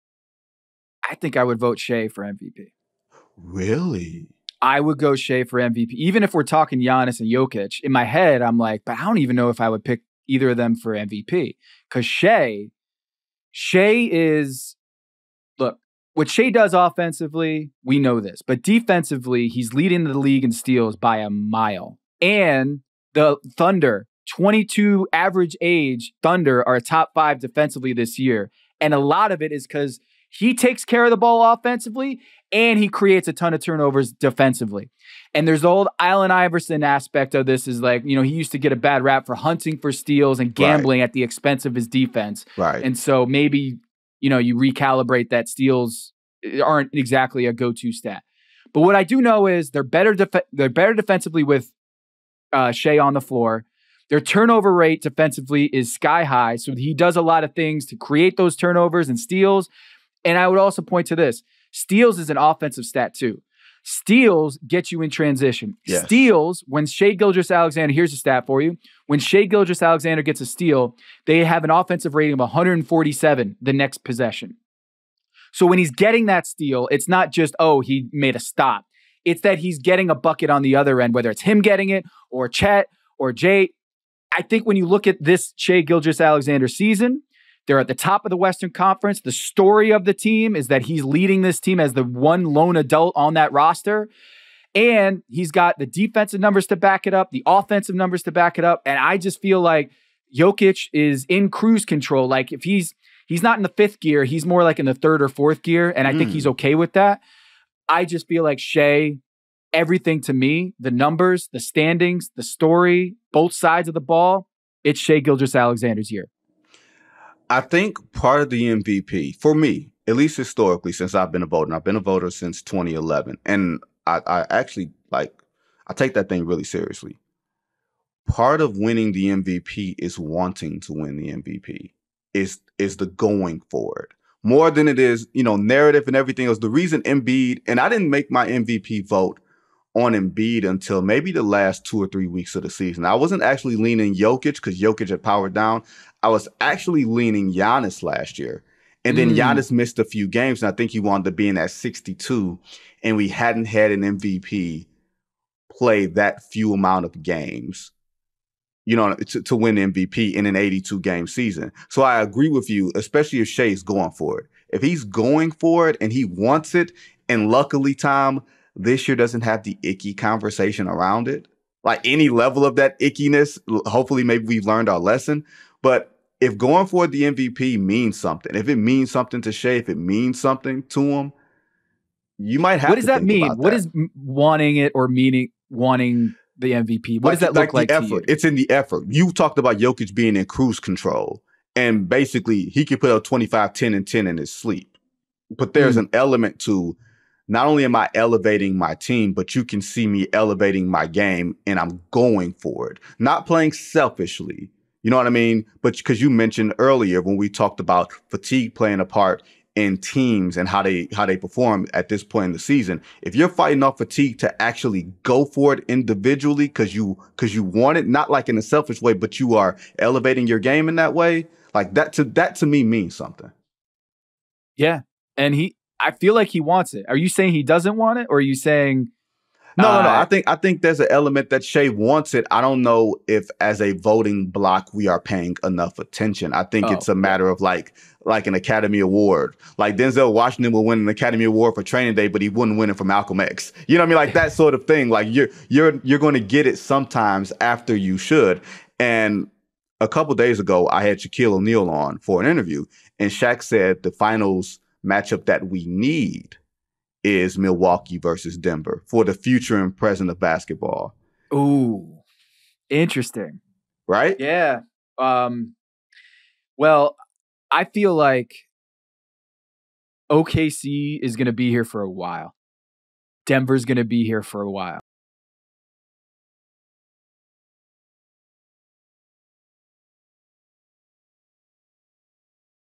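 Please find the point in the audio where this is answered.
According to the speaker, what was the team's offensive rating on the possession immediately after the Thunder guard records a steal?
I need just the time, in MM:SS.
01:12.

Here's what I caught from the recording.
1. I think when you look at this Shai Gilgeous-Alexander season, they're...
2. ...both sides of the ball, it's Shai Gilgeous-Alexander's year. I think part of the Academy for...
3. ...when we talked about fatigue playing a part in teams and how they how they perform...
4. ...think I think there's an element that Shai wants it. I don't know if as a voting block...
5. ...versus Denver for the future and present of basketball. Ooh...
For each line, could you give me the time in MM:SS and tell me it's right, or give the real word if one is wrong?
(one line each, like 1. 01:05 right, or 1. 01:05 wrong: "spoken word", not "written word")
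1. 01:24 right
2. 01:53 wrong: "MVP", not "Academy"
3. 03:27 right
4. 03:50 right
5. 04:18 right.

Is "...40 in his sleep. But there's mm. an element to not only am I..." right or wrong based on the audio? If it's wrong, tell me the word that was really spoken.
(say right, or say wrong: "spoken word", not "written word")
wrong: "10", not "40".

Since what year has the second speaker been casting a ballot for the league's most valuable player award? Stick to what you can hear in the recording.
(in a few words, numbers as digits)
2011.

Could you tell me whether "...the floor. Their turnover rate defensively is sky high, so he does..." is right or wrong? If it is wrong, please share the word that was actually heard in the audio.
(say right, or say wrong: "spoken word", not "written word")
right.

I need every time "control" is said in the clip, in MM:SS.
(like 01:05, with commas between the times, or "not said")
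01:41, 03:10.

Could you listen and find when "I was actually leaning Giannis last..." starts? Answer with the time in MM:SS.
02:26.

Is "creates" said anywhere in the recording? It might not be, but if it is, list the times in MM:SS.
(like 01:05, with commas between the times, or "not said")
00:32, 00:57.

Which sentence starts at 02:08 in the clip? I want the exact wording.
Part of winning the MVP is wanting to win the MVP.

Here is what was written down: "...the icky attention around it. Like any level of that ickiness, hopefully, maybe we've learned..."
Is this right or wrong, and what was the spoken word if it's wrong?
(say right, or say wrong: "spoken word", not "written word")
wrong: "conversation", not "attention".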